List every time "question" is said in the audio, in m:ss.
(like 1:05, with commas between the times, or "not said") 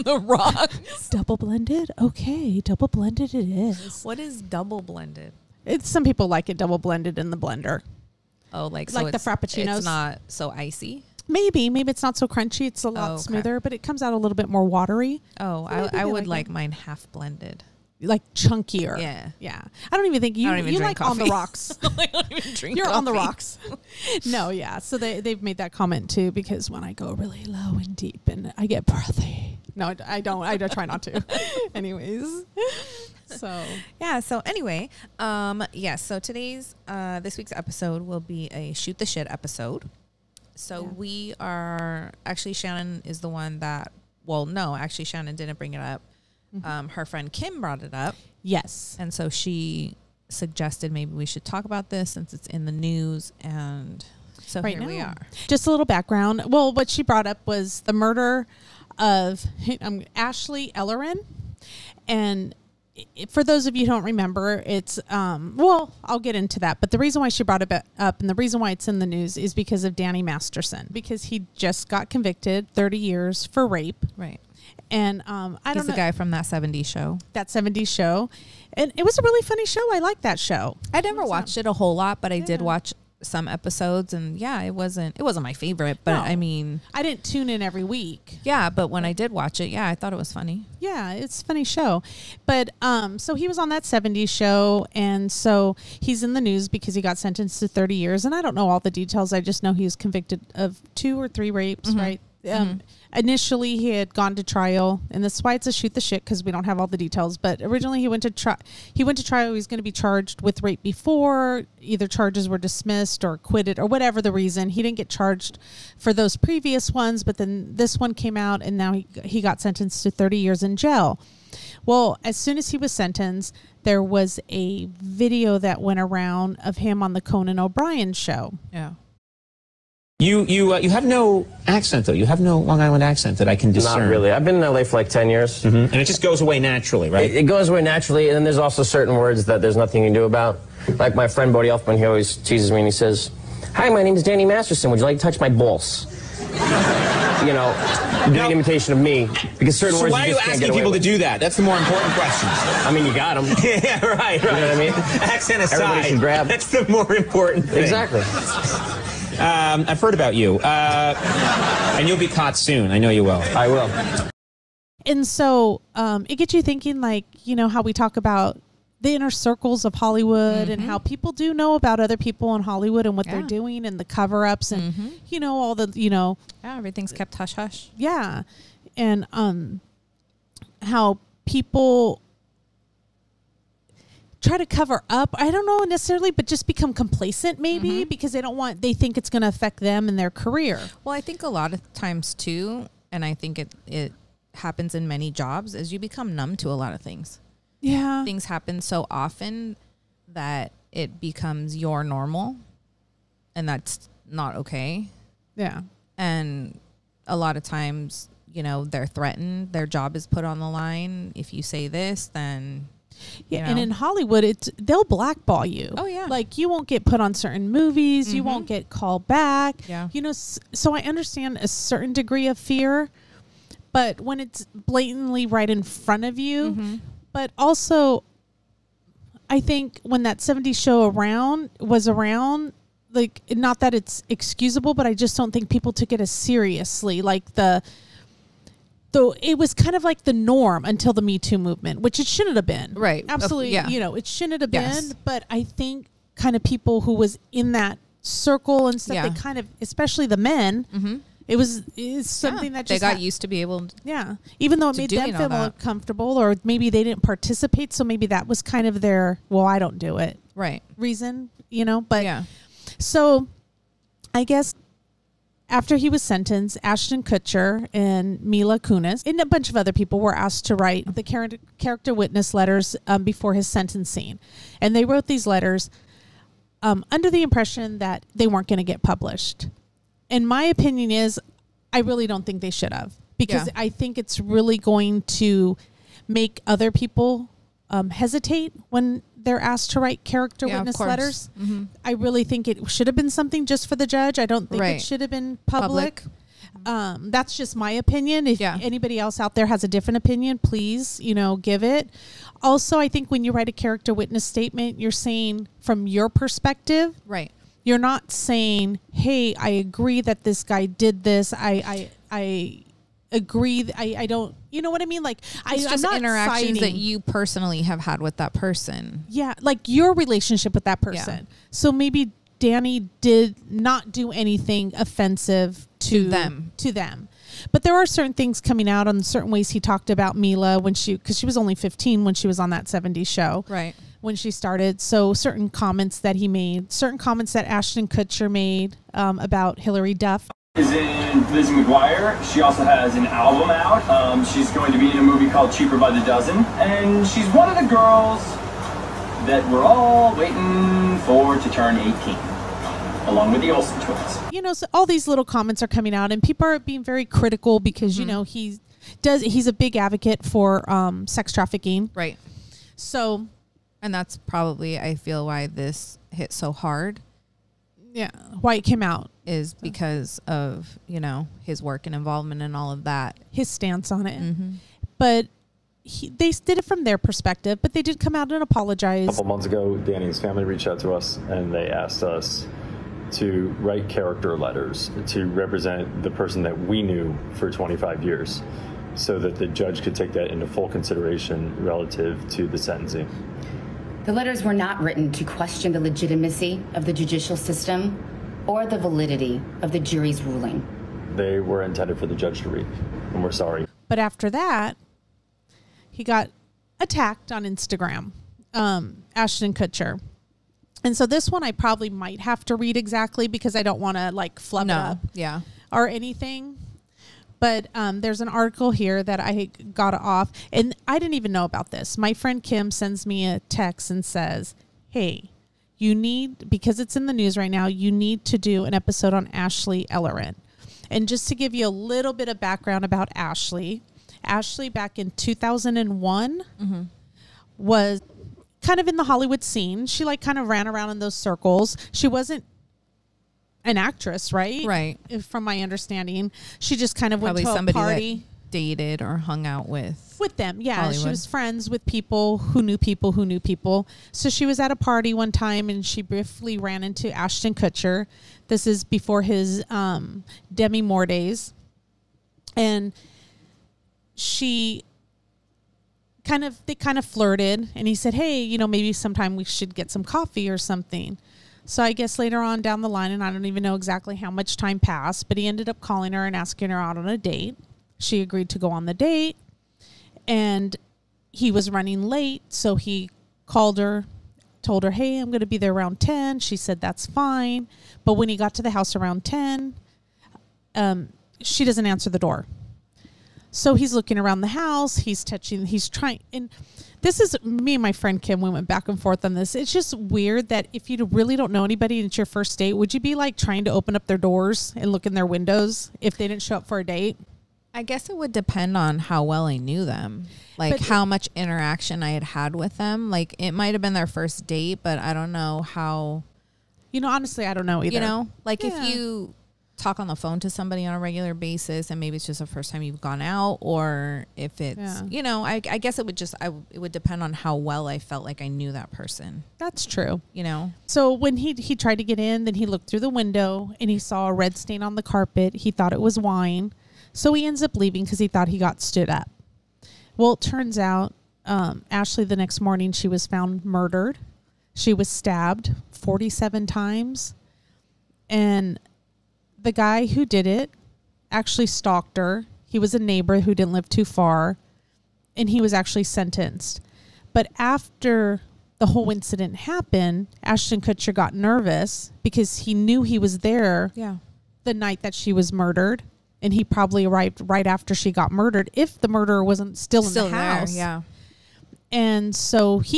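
2:32, 6:35.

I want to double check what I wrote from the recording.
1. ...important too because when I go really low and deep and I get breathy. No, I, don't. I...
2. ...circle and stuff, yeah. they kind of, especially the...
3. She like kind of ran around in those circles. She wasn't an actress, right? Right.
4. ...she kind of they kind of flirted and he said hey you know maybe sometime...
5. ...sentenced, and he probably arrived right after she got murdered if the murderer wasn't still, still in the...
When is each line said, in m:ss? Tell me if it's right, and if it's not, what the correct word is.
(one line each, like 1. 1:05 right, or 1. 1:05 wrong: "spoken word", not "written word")
1. 0:25 wrong: "comment", not "important"
2. 4:08 right
3. 7:20 right
4. 7:44 right
5. 9:25 wrong: "murdered", not "sentenced".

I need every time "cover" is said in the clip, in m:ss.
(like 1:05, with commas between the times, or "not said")
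2:54, 3:04.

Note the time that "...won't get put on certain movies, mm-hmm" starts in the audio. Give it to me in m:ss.
3:36.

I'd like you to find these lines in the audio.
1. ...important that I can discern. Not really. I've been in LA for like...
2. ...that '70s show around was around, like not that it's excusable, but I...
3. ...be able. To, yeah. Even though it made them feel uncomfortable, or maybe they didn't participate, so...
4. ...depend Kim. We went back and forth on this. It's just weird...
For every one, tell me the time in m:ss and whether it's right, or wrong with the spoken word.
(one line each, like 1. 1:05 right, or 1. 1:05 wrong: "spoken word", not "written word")
1. 2:13 wrong: "accent", not "important"
2. 3:50 right
3. 4:13 right
4. 8:18 wrong: "friend", not "depend".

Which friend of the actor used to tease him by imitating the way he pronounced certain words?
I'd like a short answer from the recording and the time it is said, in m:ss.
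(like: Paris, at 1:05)
Bodhi Elfman, at 2:21.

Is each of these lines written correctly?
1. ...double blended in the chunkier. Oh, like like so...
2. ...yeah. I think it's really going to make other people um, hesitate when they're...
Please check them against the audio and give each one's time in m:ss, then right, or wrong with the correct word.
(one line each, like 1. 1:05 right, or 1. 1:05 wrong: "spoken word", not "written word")
1. 0:06 wrong: "blender", not "chunkier"
2. 4:43 right.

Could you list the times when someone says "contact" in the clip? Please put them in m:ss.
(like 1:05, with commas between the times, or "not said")
not said.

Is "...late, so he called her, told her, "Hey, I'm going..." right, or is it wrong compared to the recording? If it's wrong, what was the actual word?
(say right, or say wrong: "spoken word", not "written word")
right.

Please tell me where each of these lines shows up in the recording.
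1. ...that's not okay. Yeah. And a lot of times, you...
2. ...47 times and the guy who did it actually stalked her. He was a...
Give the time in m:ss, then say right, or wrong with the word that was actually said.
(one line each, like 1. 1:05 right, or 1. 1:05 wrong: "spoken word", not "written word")
1. 3:23 right
2. 9:06 right.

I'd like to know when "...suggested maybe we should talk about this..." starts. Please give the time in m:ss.
0:50.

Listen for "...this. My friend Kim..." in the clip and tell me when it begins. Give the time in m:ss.
7:01.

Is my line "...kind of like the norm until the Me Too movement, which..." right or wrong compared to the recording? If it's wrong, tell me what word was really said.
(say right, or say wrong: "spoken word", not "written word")
right.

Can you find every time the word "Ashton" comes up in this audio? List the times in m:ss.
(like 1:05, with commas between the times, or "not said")
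4:26, 5:37, 6:49, 7:37, 9:20.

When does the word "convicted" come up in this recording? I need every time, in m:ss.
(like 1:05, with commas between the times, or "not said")
1:12, 1:39.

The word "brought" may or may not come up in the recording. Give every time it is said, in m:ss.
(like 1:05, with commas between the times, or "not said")
0:47, 0:57, 1:07.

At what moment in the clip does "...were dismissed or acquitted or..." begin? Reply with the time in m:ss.
1:52.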